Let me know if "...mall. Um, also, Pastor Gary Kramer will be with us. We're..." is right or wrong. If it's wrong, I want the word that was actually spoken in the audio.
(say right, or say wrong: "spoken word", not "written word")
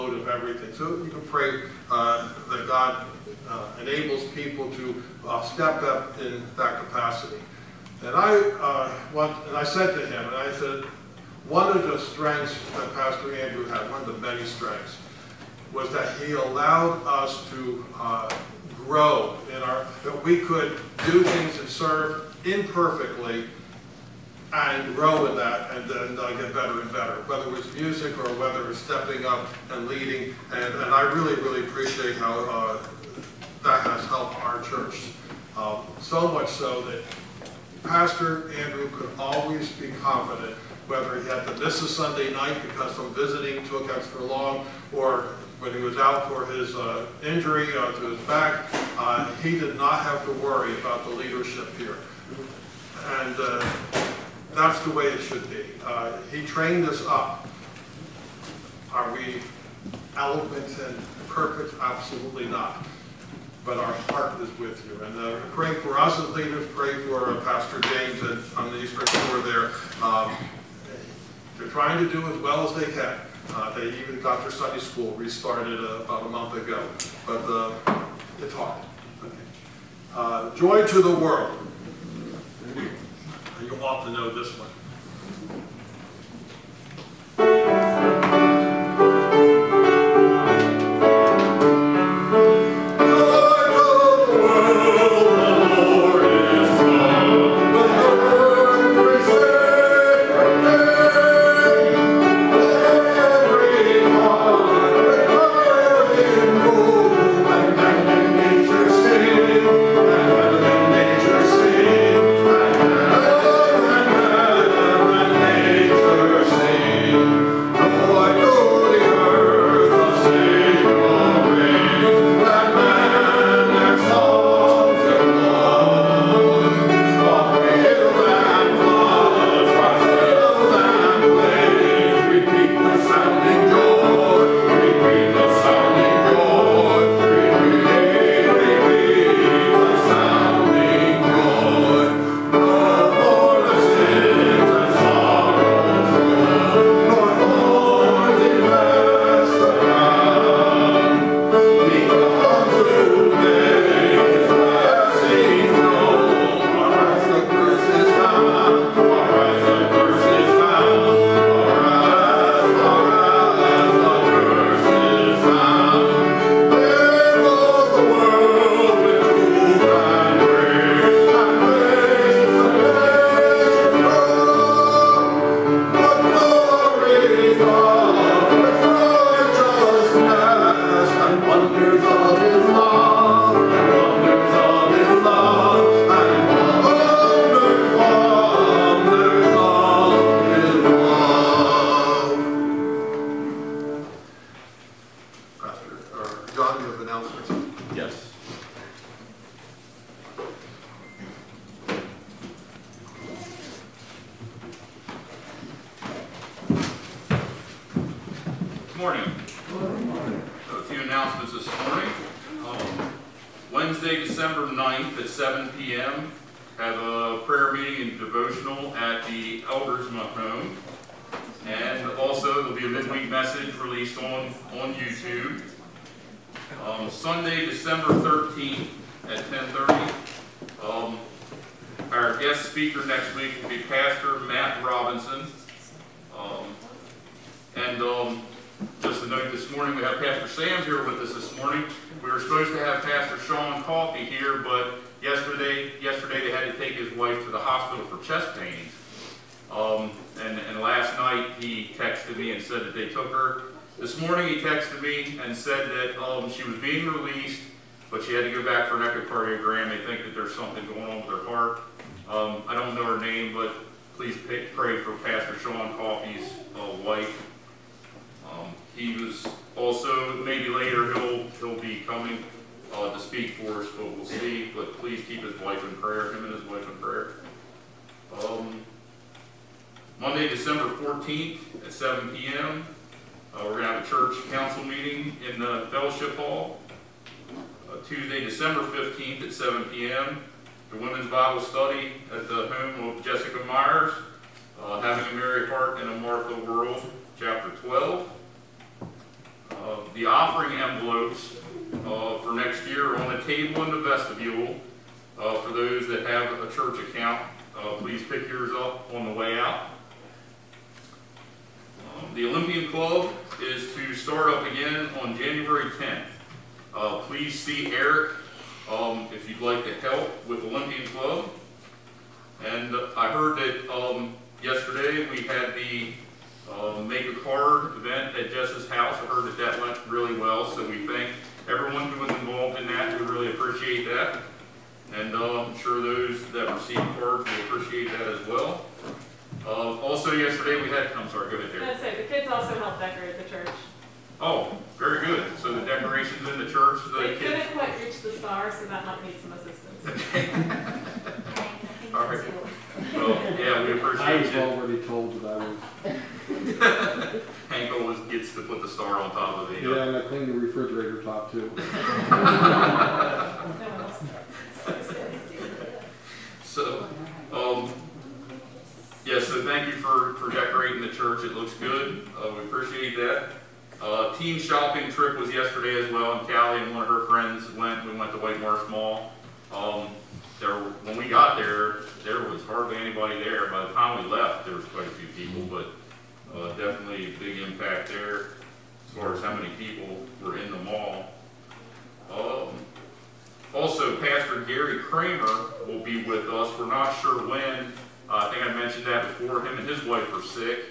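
right.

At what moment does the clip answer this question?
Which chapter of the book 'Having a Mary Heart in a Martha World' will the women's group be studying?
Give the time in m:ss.
4:57.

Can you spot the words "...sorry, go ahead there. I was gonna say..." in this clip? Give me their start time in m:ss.
5:41.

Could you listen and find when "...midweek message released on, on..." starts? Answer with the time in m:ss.
3:42.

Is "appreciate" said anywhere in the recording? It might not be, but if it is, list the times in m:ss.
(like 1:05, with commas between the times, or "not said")
0:31, 5:33, 5:37, 6:12.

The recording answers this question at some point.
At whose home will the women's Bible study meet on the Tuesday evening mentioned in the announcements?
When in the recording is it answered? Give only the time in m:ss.
4:53.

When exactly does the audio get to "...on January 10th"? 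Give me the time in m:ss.
5:15.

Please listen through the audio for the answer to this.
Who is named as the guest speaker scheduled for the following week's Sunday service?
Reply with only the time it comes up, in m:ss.
3:53.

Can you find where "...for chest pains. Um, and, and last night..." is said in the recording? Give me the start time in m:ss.
4:08.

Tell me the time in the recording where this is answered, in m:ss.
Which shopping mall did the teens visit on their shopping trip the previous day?
6:18.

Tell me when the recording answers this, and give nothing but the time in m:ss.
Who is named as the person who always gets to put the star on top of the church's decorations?
5:57.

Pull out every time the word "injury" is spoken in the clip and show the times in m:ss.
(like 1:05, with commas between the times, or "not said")
0:47.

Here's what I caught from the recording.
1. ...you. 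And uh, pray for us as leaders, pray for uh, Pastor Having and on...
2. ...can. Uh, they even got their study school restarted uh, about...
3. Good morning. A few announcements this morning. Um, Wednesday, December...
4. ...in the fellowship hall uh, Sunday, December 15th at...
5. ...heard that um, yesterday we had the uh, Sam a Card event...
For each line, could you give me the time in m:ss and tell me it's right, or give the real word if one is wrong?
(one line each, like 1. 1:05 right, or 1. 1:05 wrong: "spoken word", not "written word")
1. 1:04 wrong: "James", not "Having"
2. 1:12 right
3. 3:29 right
4. 4:45 wrong: "Tuesday", not "Sunday"
5. 5:23 wrong: "Make", not "Sam".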